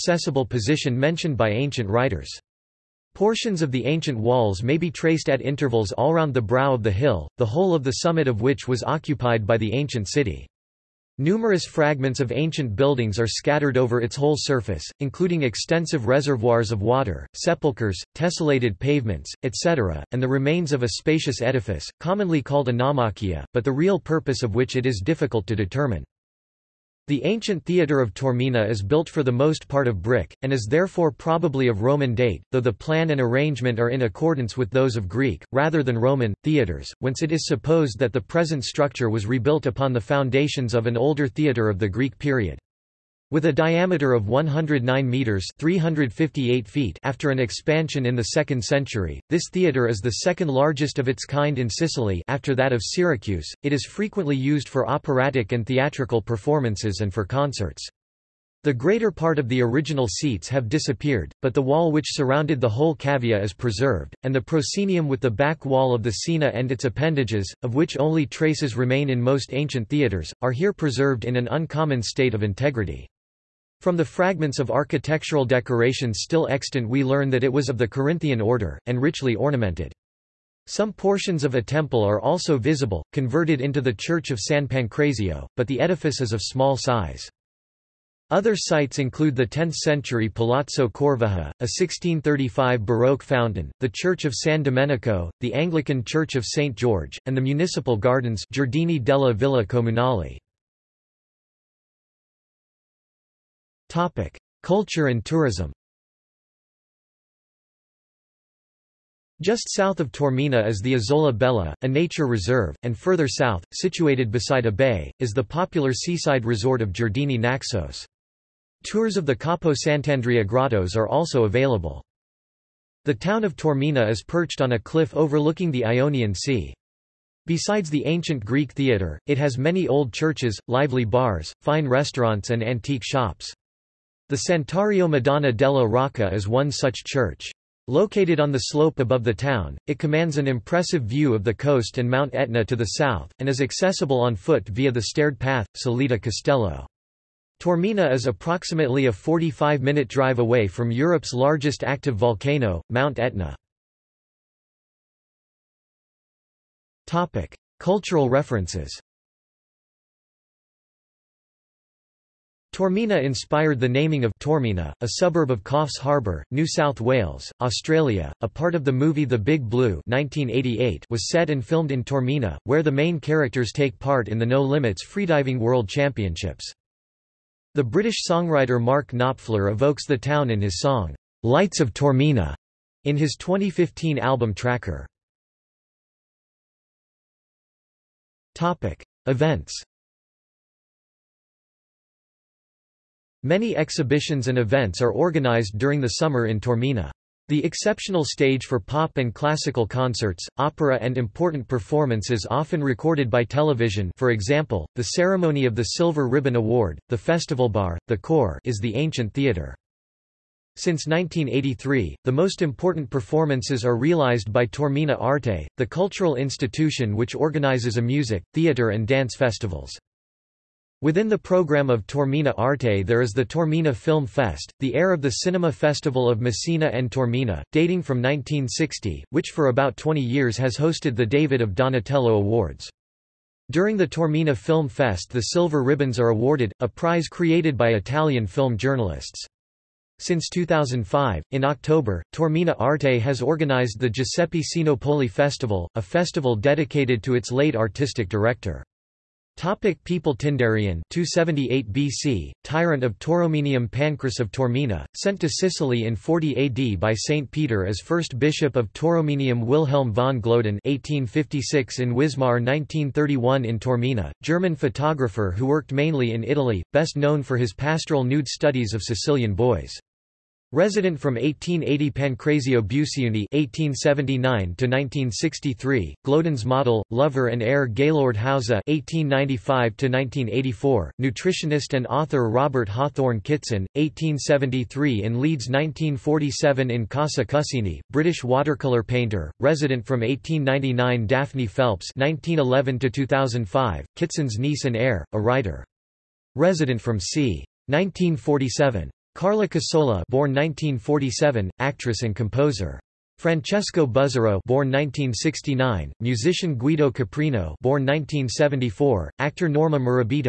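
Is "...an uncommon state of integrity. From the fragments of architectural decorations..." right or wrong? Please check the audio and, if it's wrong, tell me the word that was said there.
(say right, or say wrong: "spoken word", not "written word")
right.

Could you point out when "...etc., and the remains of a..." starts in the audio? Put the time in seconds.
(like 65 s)
19 s.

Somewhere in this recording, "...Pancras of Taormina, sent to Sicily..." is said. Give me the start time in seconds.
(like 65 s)
253 s.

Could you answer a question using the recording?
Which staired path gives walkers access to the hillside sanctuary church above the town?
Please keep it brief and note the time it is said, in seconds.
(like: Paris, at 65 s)
Salita Castello, at 145 s.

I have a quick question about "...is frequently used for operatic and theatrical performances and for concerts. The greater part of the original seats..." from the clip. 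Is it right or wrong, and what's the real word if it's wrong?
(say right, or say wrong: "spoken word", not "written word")
right.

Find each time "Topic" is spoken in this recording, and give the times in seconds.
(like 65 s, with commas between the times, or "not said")
188 s, 249 s.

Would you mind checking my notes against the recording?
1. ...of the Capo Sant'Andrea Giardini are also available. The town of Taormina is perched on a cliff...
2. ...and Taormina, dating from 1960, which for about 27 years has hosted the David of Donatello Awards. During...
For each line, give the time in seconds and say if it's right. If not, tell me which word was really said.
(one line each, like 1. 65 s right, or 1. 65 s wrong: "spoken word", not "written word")
1. 119 s wrong: "Grottos", not "Giardini"
2. 226 s wrong: "20", not "27".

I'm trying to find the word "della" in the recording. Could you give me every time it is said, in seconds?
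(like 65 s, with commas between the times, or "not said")
98 s, 135 s.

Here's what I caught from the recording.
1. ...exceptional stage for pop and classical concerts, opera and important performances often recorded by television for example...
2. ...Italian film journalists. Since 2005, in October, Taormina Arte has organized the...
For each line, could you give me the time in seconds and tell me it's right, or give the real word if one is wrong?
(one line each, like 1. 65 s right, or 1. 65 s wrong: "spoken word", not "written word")
1. 197 s right
2. 237 s right.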